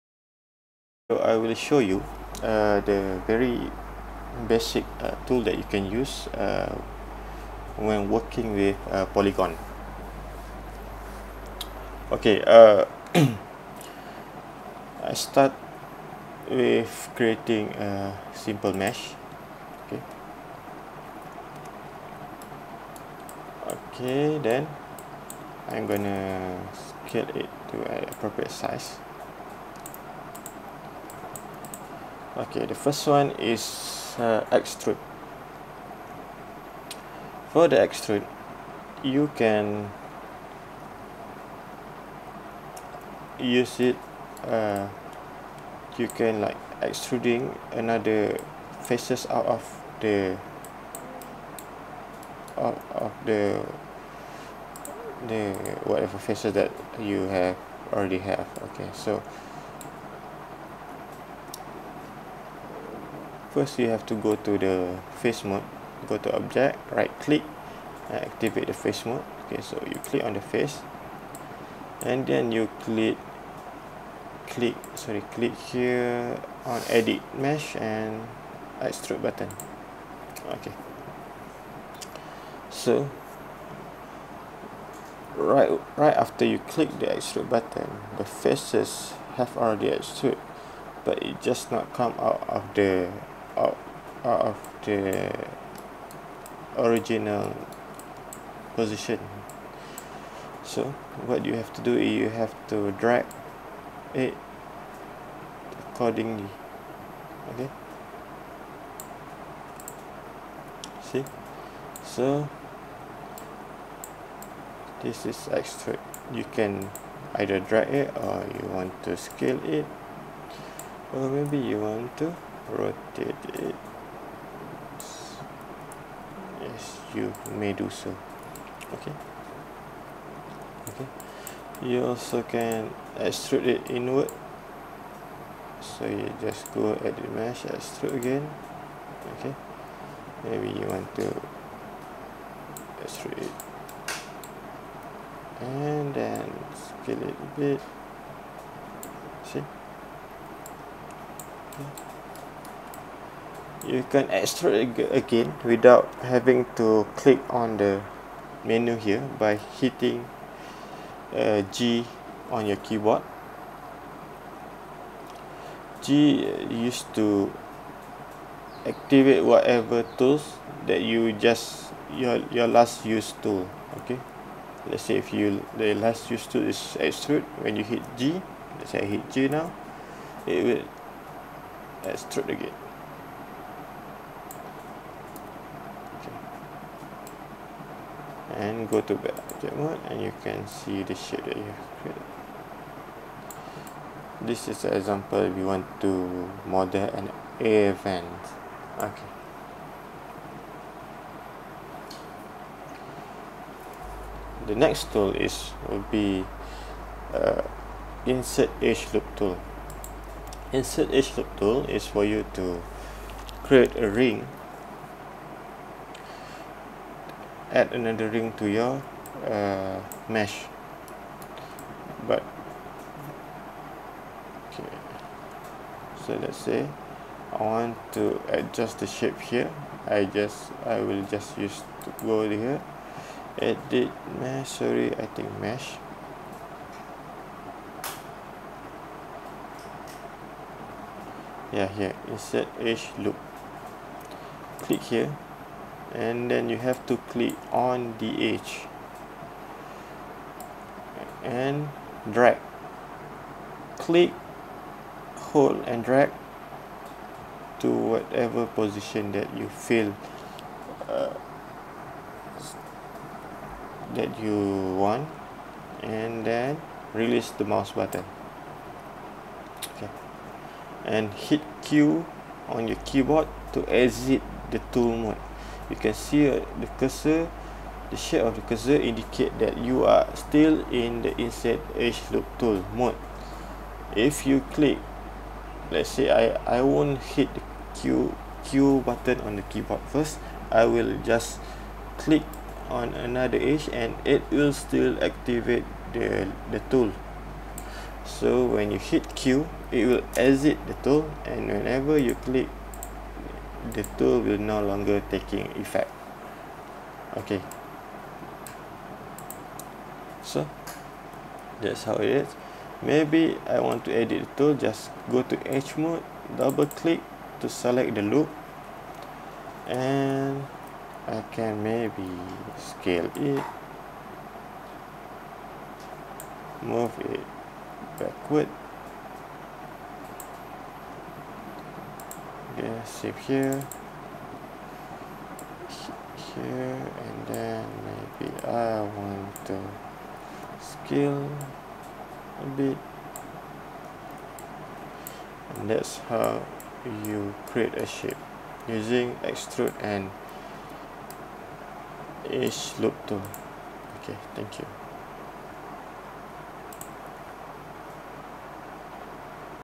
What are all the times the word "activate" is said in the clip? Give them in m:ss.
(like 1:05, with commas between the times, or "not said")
1:08, 2:48, 4:55.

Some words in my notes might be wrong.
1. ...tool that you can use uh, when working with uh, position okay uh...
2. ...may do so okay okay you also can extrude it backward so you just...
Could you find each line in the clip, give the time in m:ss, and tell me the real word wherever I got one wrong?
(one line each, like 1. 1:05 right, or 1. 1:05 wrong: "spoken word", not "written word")
1. 0:05 wrong: "polygon", not "position"
2. 2:07 wrong: "inward", not "backward".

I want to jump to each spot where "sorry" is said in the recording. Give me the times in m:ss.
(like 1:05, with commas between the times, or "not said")
1:14, 3:54.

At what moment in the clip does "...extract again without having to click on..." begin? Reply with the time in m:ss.
2:34.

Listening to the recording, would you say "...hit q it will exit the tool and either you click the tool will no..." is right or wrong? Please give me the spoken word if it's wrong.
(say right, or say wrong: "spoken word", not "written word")
wrong: "whenever", not "either".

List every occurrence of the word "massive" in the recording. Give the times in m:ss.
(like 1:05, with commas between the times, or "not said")
not said.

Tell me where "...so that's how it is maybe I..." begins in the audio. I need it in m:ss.
5:10.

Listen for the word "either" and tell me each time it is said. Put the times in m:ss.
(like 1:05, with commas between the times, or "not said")
1:57.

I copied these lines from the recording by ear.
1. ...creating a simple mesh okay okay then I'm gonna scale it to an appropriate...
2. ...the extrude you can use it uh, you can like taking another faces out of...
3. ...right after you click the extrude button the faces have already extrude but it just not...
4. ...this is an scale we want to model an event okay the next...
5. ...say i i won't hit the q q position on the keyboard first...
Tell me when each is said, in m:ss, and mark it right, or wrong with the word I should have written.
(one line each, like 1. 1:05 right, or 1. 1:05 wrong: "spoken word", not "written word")
1. 0:17 right
2. 0:37 wrong: "extruding", not "taking"
3. 1:25 right
4. 3:14 wrong: "example", not "scale"
5. 4:46 wrong: "button", not "position".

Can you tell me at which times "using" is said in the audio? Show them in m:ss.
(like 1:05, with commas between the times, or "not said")
5:48.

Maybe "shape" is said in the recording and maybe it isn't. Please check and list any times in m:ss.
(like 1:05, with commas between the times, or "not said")
3:11, 3:49, 4:38, 5:48.